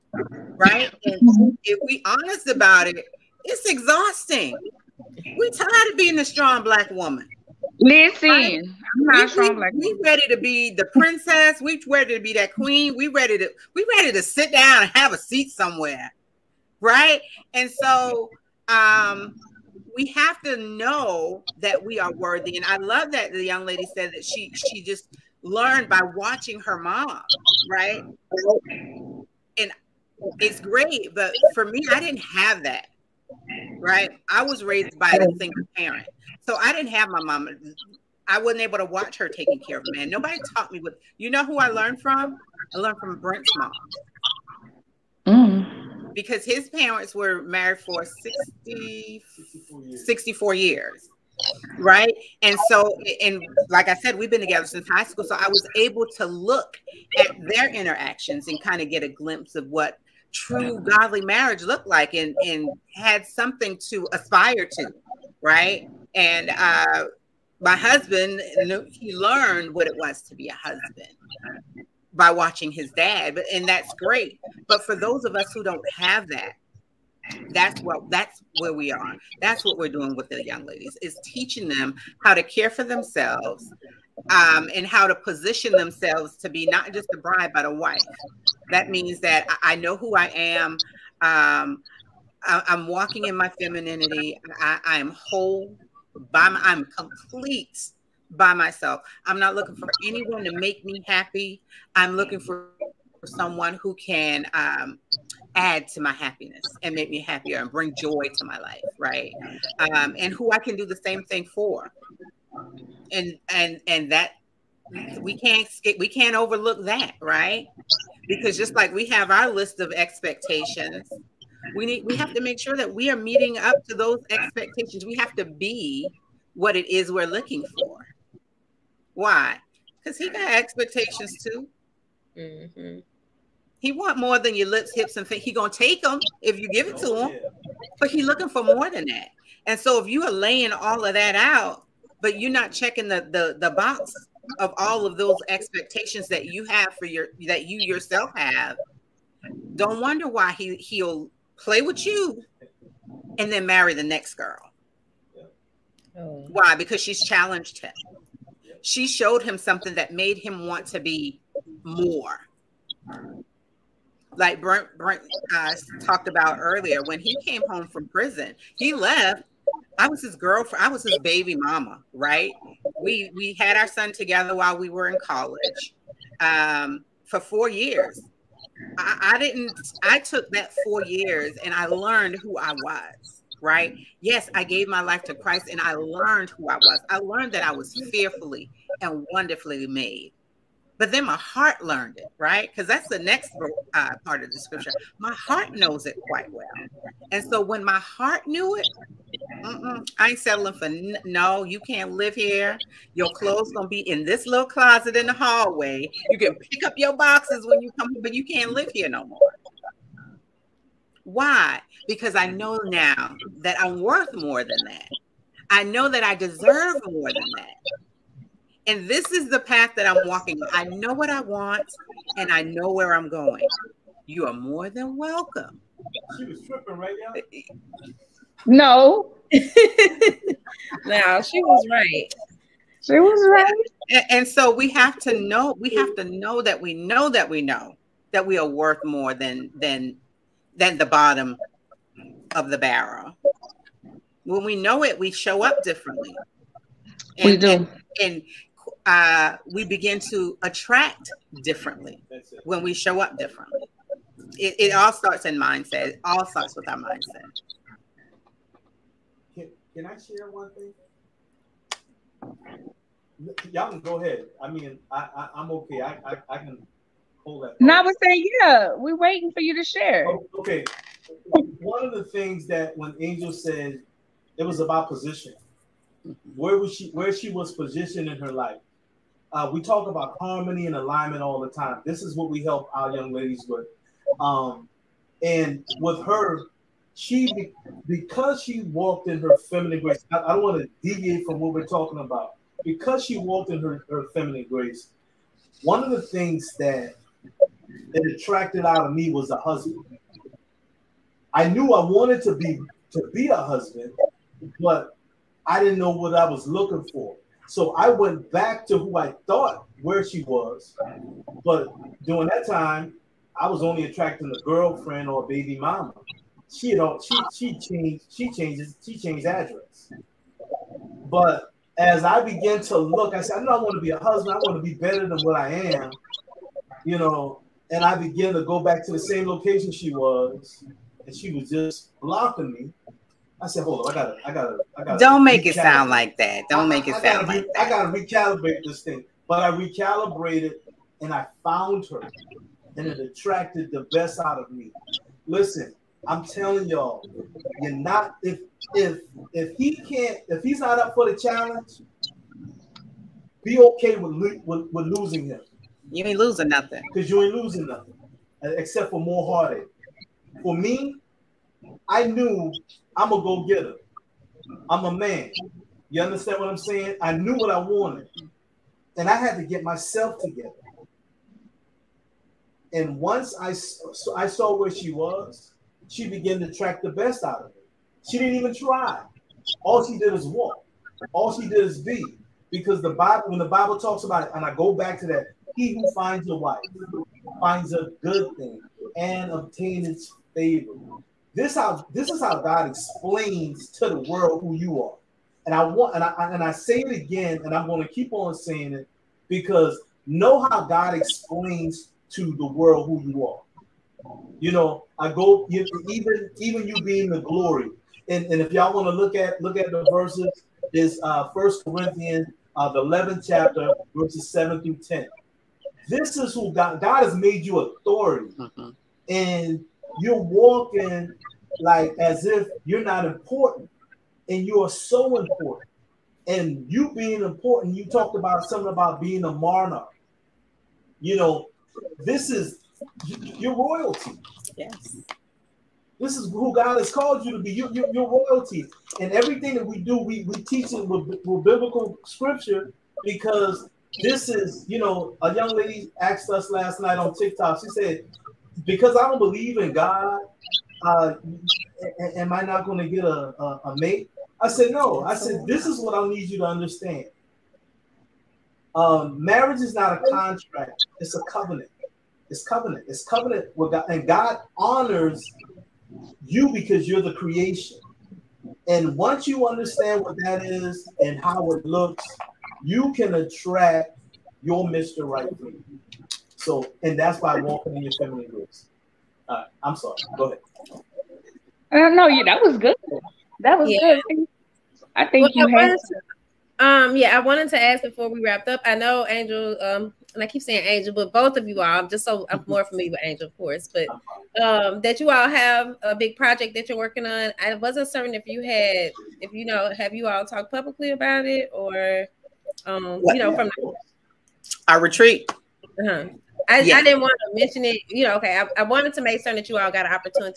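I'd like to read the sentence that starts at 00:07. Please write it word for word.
Listen, I'm not we, strong black.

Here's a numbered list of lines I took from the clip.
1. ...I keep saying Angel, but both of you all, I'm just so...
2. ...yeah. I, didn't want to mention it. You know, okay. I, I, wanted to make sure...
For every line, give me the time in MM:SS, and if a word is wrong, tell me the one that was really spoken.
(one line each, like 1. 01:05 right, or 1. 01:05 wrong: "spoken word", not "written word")
1. 08:10 right
2. 08:26 right.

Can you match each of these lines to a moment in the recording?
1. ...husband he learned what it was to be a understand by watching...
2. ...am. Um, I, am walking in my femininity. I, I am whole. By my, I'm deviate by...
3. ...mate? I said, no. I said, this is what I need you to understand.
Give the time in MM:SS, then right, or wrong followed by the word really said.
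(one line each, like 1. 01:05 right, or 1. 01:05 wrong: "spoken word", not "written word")
1. 01:07 wrong: "husband", not "understand"
2. 01:30 wrong: "complete", not "deviate"
3. 07:33 right.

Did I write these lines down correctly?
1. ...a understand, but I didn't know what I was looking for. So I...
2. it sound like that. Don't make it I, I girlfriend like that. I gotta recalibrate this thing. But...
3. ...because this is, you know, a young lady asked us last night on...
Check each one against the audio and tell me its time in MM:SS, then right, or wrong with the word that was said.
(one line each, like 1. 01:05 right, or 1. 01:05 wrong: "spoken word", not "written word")
1. 05:03 wrong: "husband", not "understand"
2. 05:35 wrong: "sound", not "girlfriend"
3. 07:23 right.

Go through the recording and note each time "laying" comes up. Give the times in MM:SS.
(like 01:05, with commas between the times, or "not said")
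02:20.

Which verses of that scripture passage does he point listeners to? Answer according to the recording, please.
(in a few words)
7 through 10.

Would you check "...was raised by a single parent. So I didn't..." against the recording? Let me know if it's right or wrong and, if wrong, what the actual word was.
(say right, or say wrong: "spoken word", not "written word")
right.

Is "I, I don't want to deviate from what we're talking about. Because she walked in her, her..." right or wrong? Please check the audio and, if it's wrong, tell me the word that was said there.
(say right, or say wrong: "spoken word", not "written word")
right.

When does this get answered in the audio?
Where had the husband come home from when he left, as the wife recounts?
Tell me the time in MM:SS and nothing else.
02:48.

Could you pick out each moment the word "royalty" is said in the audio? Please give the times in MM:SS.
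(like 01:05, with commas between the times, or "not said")
07:13, 07:18.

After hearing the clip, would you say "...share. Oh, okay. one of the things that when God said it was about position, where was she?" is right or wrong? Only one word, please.
wrong.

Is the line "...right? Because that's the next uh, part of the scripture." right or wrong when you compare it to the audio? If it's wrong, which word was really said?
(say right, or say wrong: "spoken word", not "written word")
right.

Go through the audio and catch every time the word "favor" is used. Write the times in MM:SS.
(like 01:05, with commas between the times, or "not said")
06:30.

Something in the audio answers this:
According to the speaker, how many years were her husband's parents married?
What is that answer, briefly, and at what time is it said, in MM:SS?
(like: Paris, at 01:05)
64 years, at 00:50.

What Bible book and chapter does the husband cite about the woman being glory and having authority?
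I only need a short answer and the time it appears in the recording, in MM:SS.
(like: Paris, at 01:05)
First Corinthians 11, at 06:51.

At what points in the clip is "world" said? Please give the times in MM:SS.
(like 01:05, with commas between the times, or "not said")
06:34, 06:42.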